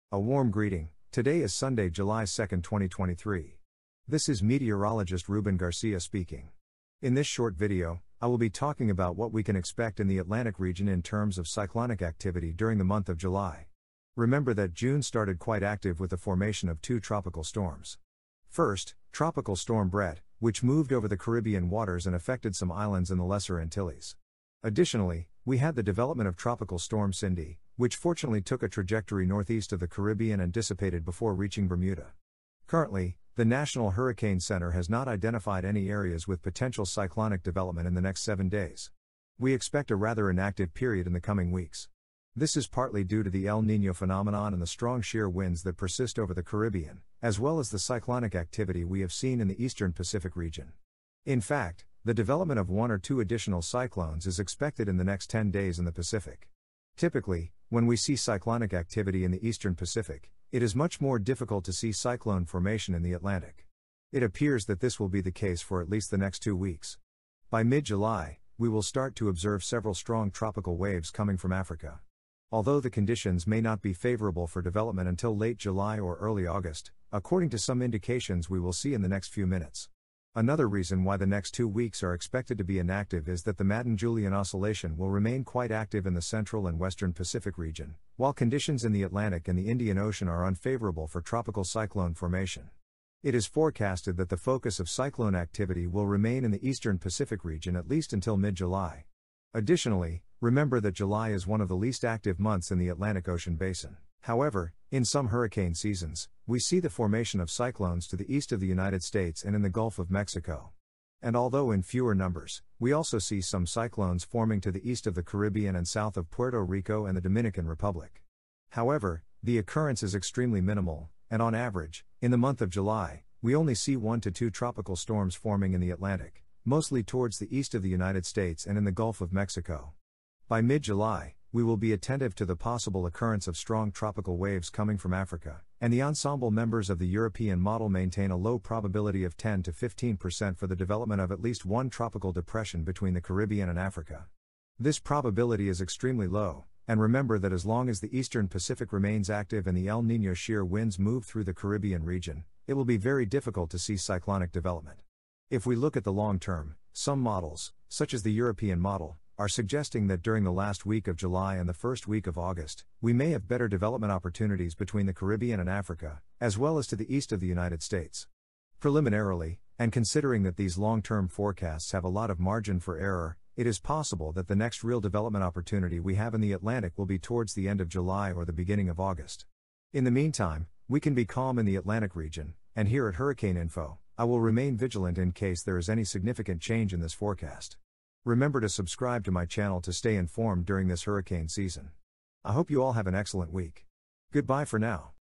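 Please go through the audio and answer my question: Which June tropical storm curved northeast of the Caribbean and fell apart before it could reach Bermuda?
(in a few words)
Cindy.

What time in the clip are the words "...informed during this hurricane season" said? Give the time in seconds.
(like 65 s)
190 s.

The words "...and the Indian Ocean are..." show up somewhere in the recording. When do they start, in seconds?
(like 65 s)
89 s.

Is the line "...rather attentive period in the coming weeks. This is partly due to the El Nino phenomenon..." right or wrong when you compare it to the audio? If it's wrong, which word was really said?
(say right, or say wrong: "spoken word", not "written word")
wrong: "inactive", not "attentive".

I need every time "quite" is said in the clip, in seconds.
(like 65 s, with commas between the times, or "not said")
15 s, 85 s.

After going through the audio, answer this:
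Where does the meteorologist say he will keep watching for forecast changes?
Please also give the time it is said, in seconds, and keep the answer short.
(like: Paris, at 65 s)
Hurricane Info, at 183 s.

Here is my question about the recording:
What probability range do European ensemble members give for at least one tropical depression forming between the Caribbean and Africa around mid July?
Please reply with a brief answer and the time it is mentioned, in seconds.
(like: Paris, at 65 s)
10 to 15%, at 139 s.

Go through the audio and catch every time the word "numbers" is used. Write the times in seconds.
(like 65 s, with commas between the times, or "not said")
112 s.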